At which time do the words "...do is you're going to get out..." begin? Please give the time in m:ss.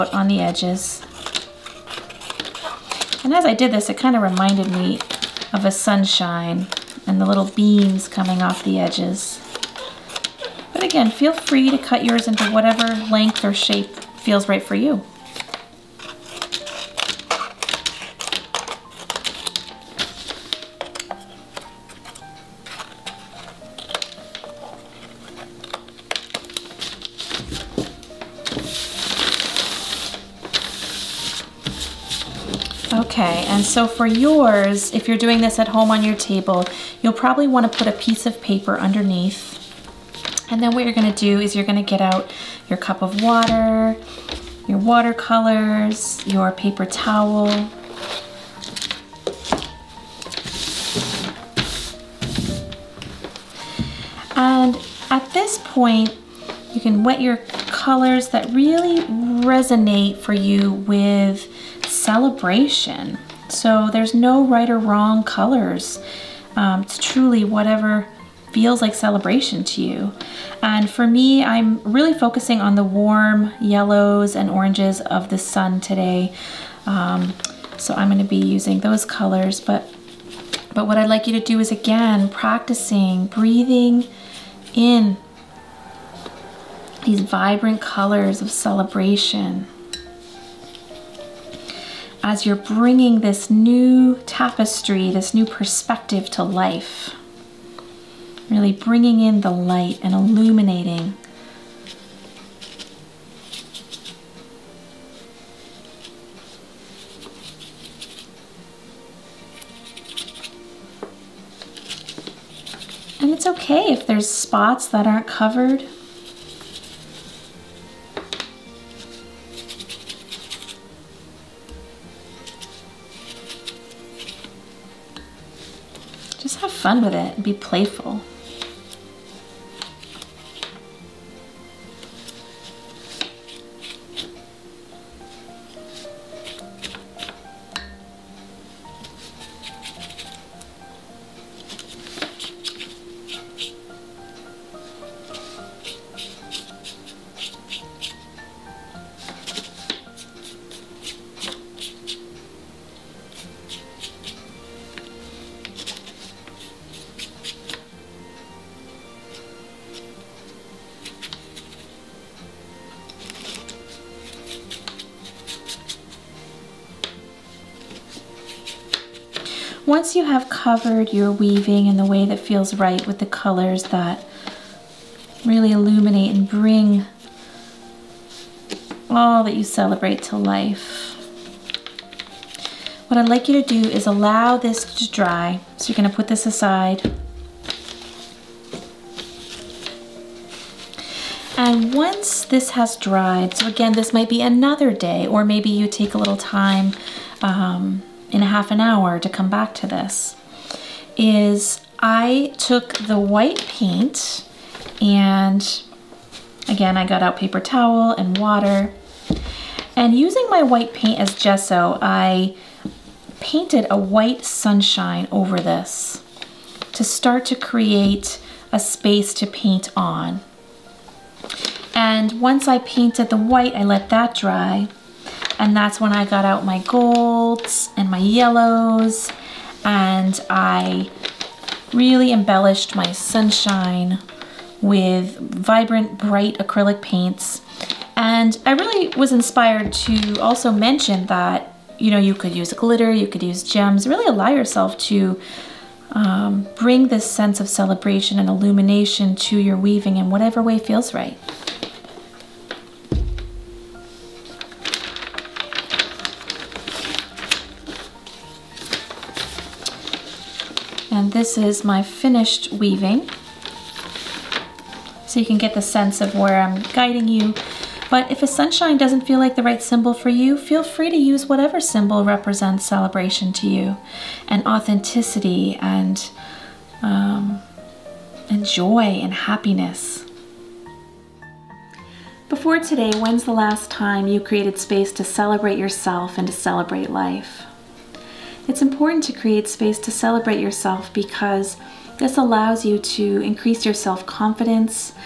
0:41.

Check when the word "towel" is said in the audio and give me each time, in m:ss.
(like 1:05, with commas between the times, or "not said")
0:46, 3:27.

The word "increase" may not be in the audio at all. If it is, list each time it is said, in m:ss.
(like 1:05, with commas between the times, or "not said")
4:53.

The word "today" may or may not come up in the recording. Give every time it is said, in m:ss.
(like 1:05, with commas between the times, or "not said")
1:15, 4:42.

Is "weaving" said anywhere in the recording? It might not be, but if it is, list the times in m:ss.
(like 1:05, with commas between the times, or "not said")
2:51, 4:09, 4:22.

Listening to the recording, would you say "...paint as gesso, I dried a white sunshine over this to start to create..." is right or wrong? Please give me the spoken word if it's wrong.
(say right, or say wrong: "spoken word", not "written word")
wrong: "painted", not "dried".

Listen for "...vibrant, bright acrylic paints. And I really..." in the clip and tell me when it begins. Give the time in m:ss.
3:55.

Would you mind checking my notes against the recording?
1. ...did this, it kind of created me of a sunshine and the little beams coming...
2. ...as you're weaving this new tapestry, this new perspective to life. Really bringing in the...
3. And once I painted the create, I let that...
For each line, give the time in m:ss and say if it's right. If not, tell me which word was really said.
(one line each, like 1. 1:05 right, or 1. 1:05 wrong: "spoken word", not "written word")
1. 0:03 wrong: "reminded", not "created"
2. 1:32 wrong: "bringing", not "weaving"
3. 3:41 wrong: "white", not "create".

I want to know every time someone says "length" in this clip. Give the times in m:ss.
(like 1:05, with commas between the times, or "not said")
0:13.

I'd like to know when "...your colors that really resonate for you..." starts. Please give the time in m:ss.
0:57.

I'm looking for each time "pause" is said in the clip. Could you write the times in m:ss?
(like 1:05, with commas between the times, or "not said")
not said.